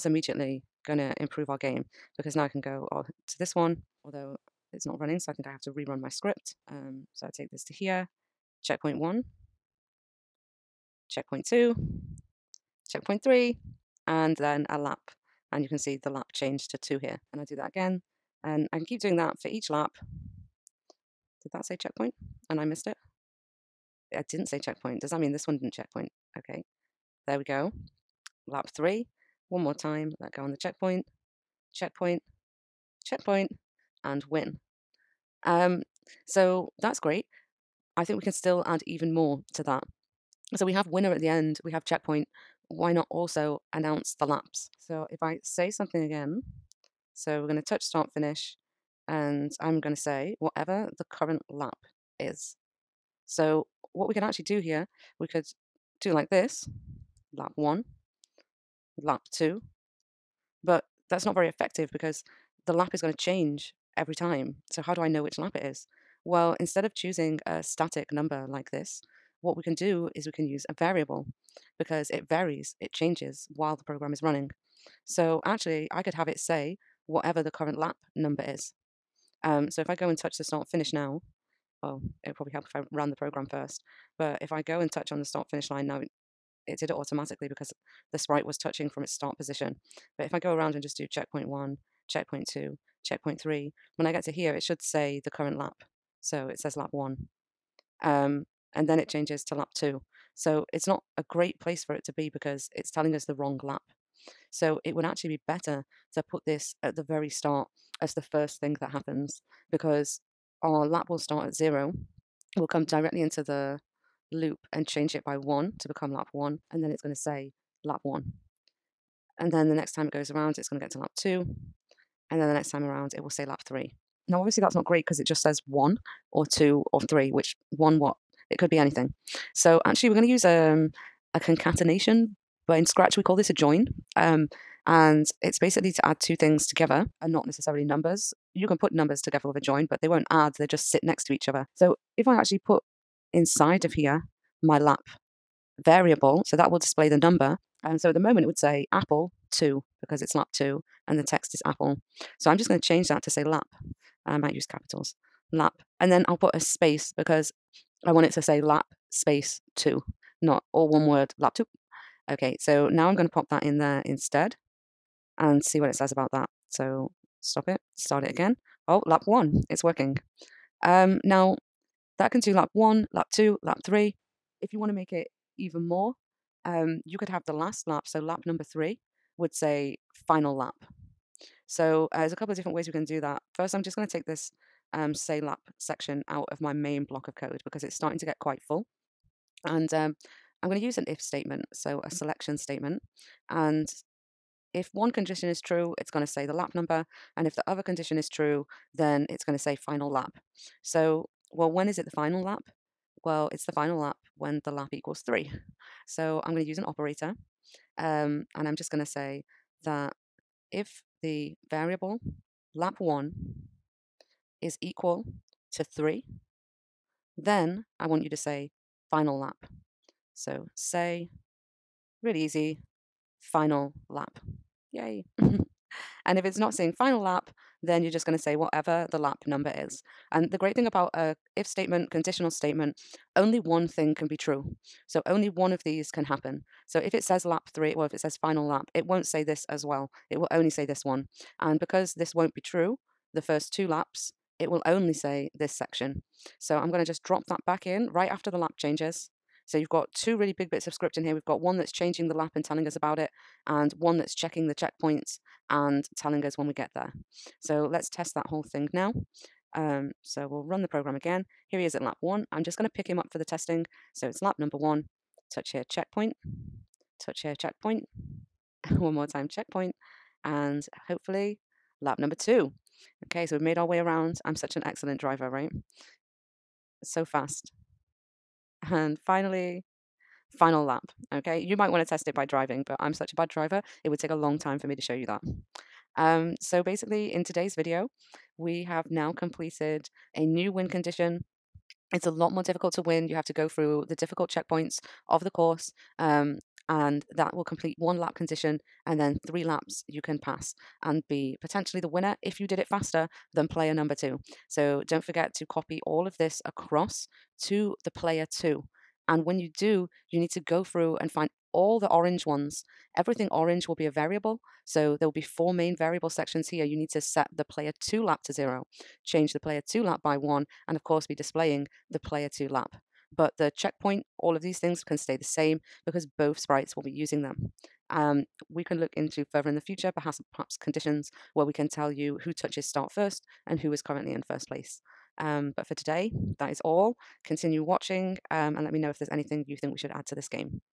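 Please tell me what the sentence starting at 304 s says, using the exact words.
So don't forget to copy all of this across to the player two.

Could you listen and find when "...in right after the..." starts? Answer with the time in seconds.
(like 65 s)
247 s.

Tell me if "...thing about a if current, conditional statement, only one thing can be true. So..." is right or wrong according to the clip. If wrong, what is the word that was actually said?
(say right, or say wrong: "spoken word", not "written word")
wrong: "statement", not "current".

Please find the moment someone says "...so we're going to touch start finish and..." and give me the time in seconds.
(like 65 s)
47 s.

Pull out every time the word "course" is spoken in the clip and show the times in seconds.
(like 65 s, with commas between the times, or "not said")
295 s, 321 s.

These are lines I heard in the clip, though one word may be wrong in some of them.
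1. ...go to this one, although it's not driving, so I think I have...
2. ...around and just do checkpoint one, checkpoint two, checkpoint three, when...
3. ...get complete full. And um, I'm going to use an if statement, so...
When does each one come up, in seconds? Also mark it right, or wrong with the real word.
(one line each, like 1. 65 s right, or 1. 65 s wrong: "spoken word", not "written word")
1. 2 s wrong: "running", not "driving"
2. 90 s right
3. 188 s wrong: "quite", not "complete".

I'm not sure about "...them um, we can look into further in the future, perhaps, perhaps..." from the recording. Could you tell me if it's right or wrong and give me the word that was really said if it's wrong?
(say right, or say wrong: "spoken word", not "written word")
right.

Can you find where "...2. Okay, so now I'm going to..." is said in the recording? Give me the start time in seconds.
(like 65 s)
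161 s.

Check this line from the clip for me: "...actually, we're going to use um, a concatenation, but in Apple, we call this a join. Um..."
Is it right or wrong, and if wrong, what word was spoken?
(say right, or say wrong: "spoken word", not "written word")
wrong: "Scratch", not "Apple".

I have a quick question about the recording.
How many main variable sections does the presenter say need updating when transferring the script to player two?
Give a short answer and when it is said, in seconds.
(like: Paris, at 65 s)
4, at 315 s.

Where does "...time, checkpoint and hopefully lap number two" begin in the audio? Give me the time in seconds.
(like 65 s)
269 s.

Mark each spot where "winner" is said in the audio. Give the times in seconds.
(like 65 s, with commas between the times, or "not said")
40 s, 302 s.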